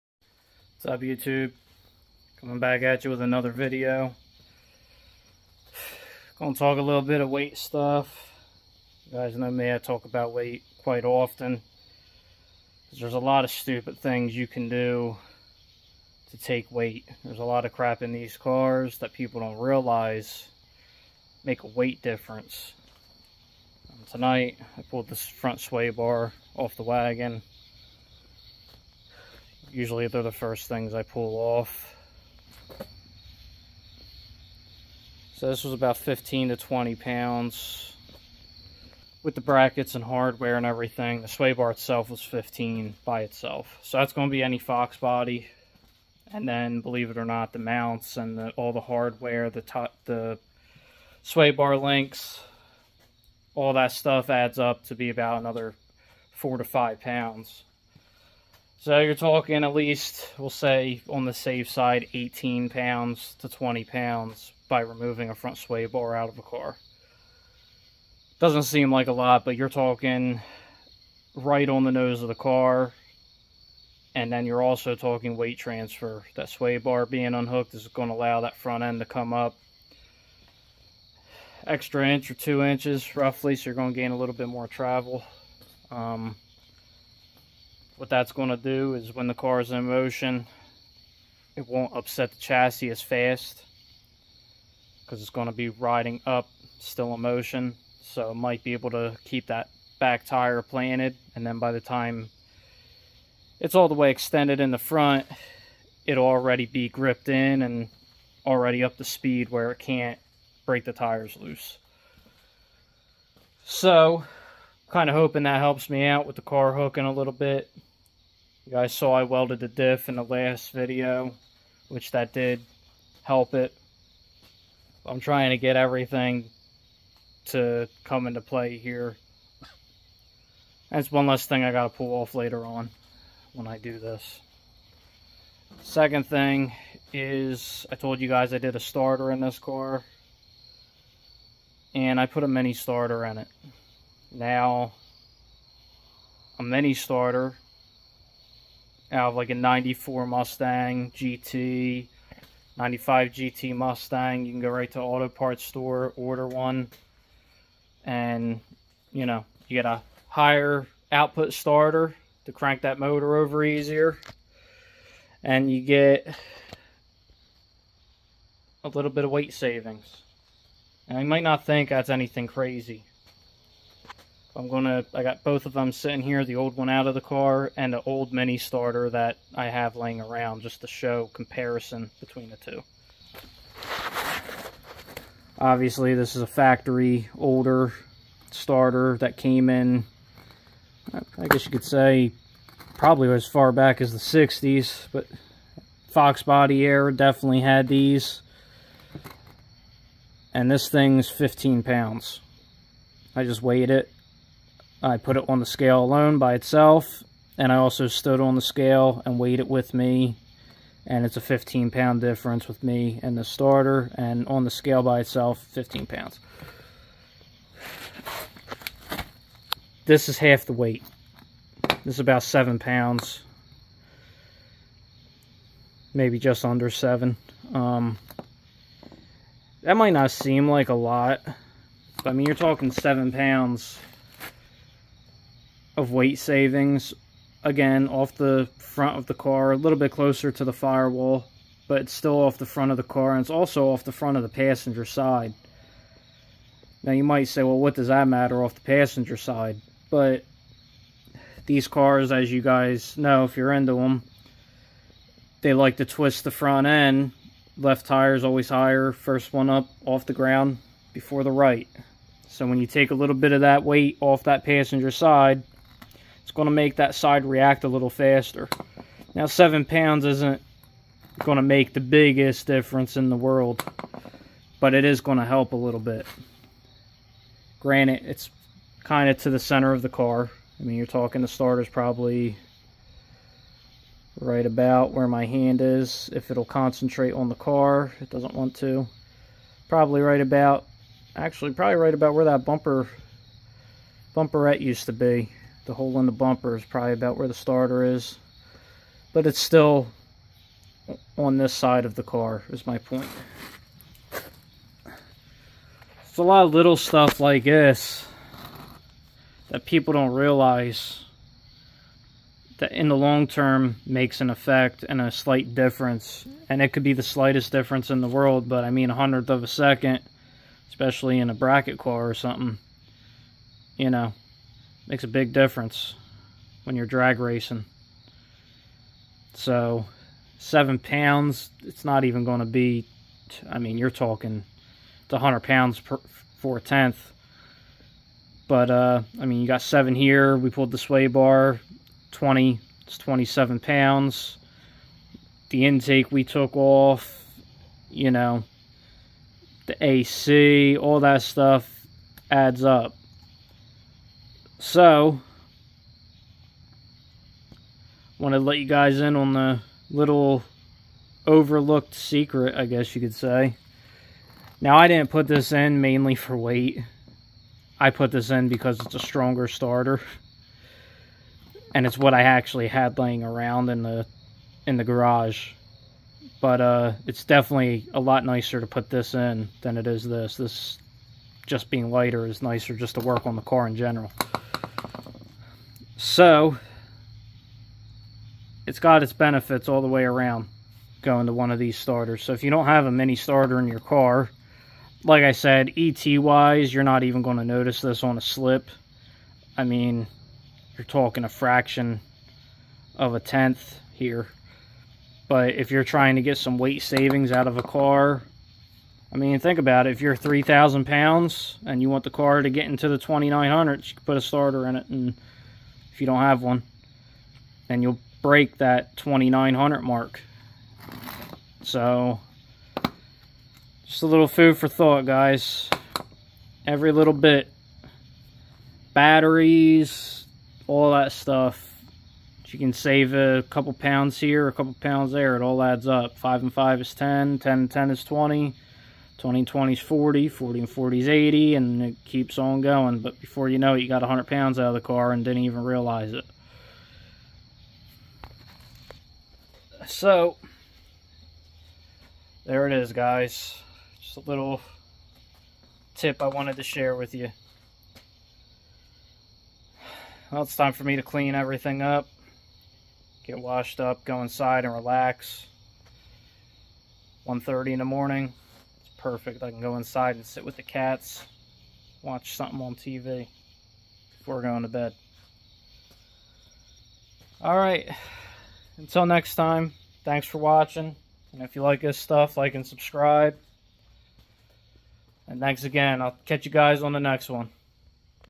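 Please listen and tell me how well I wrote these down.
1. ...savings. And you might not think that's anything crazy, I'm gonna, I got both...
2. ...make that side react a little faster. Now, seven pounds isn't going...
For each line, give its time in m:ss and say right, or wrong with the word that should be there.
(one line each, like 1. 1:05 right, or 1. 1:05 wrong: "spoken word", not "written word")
1. 2:49 right
2. 4:26 right.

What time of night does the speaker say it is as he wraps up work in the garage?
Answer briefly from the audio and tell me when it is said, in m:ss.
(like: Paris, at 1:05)
1:30, at 7:47.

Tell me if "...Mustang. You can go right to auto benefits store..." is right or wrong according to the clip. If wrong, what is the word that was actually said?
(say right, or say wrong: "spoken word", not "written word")
wrong: "parts", not "benefits".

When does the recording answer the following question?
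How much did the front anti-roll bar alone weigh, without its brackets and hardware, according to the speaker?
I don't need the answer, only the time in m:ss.
0:41.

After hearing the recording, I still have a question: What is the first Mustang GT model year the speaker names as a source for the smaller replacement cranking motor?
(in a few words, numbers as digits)
1994.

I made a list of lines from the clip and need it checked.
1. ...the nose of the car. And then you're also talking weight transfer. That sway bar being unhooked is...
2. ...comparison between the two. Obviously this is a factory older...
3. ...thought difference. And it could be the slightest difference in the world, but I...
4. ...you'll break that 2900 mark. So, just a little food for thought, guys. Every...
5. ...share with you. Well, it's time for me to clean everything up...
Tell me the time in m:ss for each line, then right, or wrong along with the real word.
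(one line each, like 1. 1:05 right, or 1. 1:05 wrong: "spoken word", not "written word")
1. 1:11 right
2. 3:01 right
3. 5:15 wrong: "slight", not "thought"
4. 6:58 right
5. 7:36 right.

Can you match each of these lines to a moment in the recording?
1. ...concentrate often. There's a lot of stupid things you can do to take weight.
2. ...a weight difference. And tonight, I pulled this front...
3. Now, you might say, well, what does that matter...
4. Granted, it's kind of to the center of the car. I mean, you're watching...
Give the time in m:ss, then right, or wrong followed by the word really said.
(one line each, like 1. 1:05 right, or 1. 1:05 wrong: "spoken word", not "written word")
1. 0:10 wrong: "quite", not "concentrate"
2. 0:21 right
3. 4:07 right
4. 4:37 wrong: "talking", not "watching".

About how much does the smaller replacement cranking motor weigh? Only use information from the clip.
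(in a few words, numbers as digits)
about 7 pounds.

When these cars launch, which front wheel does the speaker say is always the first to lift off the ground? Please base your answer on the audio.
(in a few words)
left.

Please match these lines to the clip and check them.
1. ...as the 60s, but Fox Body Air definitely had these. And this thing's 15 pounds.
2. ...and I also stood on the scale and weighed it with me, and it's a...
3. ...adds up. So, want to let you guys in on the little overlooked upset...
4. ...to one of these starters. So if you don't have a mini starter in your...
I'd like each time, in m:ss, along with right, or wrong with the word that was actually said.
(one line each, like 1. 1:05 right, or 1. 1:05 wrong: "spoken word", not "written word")
1. 3:14 right
2. 3:27 right
3. 5:52 wrong: "secret", not "upset"
4. 6:31 right.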